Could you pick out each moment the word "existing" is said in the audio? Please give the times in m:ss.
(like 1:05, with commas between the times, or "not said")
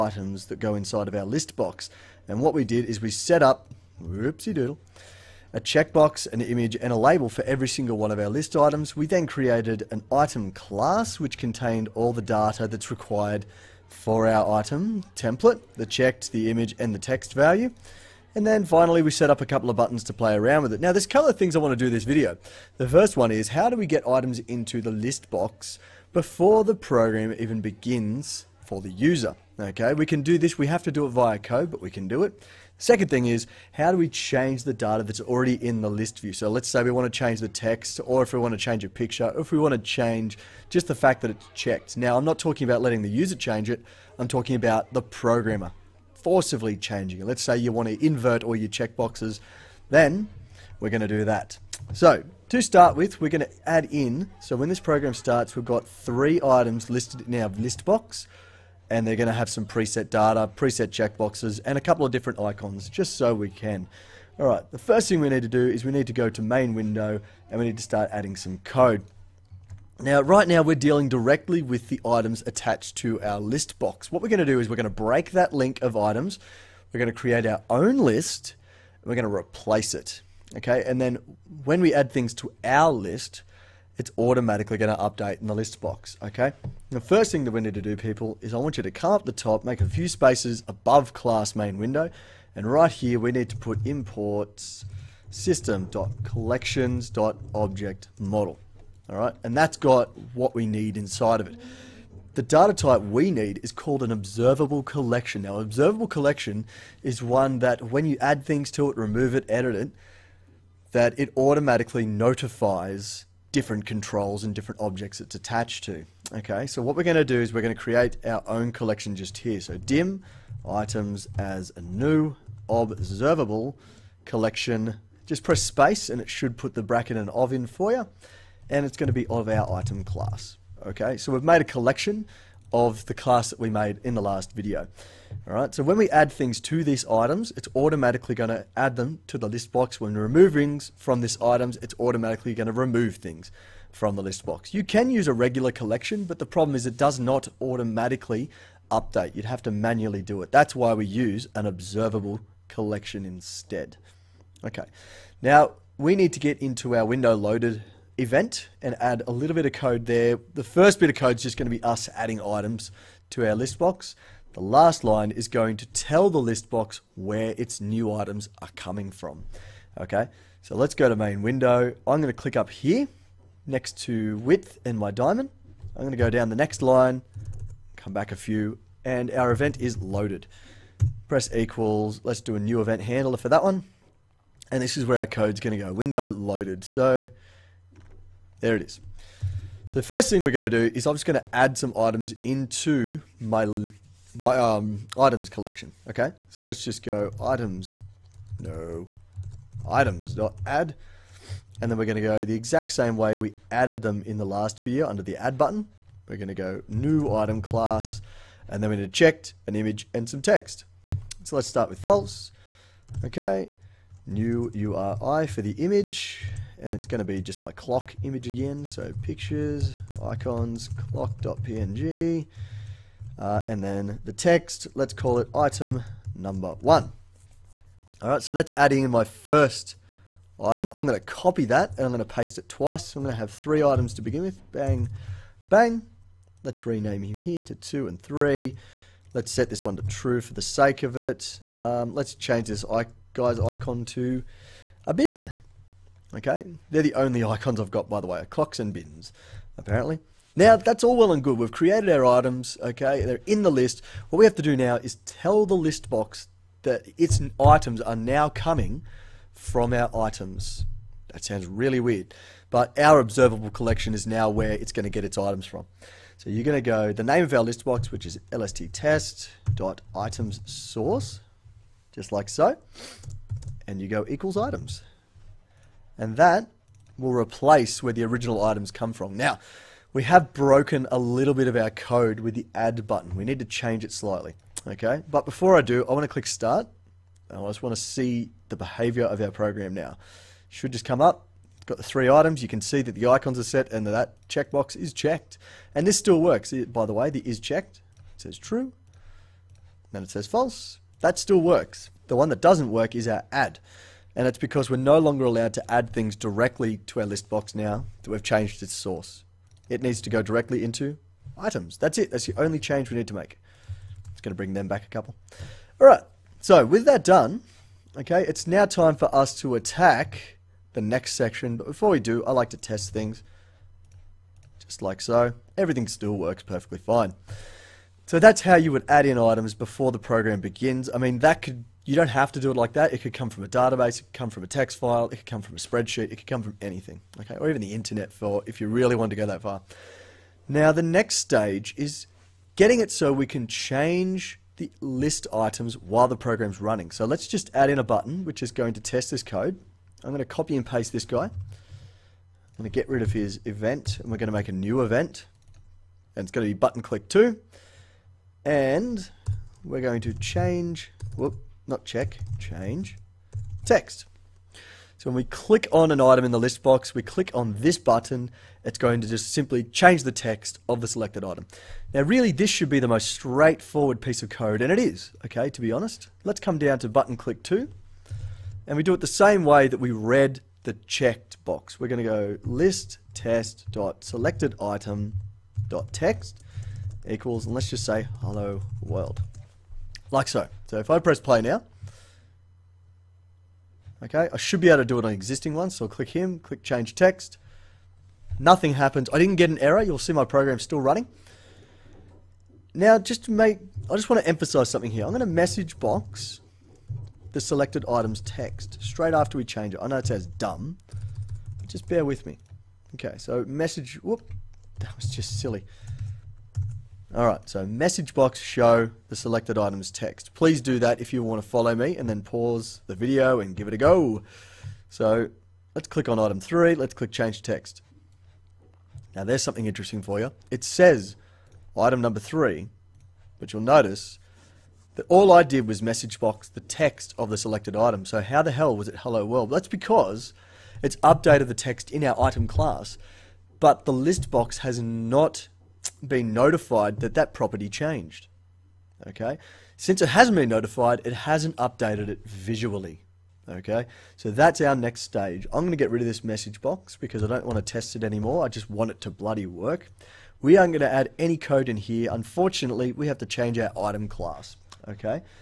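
6:35.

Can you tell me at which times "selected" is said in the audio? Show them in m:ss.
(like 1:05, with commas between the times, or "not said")
6:11, 6:24, 6:47, 6:59, 7:17.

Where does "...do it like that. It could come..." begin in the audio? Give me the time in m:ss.
5:32.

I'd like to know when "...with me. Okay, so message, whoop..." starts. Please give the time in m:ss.
6:52.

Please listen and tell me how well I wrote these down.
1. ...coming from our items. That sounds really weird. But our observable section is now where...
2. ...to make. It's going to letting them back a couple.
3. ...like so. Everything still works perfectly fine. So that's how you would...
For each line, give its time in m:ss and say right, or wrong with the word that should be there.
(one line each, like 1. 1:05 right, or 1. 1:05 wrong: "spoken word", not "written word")
1. 4:18 wrong: "collection", not "section"
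2. 5:13 wrong: "bring", not "letting"
3. 5:25 right.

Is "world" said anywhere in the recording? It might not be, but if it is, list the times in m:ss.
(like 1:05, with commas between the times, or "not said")
6:29, 7:19.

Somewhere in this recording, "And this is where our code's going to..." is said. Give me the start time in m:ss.
3:04.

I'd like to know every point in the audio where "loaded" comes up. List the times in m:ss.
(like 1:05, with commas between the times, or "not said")
2:37, 2:59, 3:06.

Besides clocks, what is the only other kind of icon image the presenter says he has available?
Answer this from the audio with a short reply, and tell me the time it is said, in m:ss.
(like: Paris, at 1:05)
bins, at 4:08.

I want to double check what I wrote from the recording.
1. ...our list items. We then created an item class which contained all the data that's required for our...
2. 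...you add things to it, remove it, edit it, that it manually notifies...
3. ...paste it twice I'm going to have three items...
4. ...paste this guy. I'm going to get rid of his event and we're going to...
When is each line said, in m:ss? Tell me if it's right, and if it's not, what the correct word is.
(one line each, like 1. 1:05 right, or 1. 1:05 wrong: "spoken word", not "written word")
1. 0:08 right
2. 1:48 wrong: "automatically", not "manually"
3. 3:52 right
4. 5:50 right.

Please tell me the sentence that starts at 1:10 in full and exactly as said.
Now, right now, we're dealing directly with the items attached to our list box.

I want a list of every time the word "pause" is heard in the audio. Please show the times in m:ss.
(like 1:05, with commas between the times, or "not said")
7:02.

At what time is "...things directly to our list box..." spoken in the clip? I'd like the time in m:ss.
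5:06.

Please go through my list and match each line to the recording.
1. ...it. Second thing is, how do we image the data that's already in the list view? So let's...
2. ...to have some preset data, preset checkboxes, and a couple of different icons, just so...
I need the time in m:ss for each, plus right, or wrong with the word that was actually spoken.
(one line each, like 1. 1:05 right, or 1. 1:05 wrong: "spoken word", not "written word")
1. 0:32 wrong: "change", not "image"
2. 0:59 right.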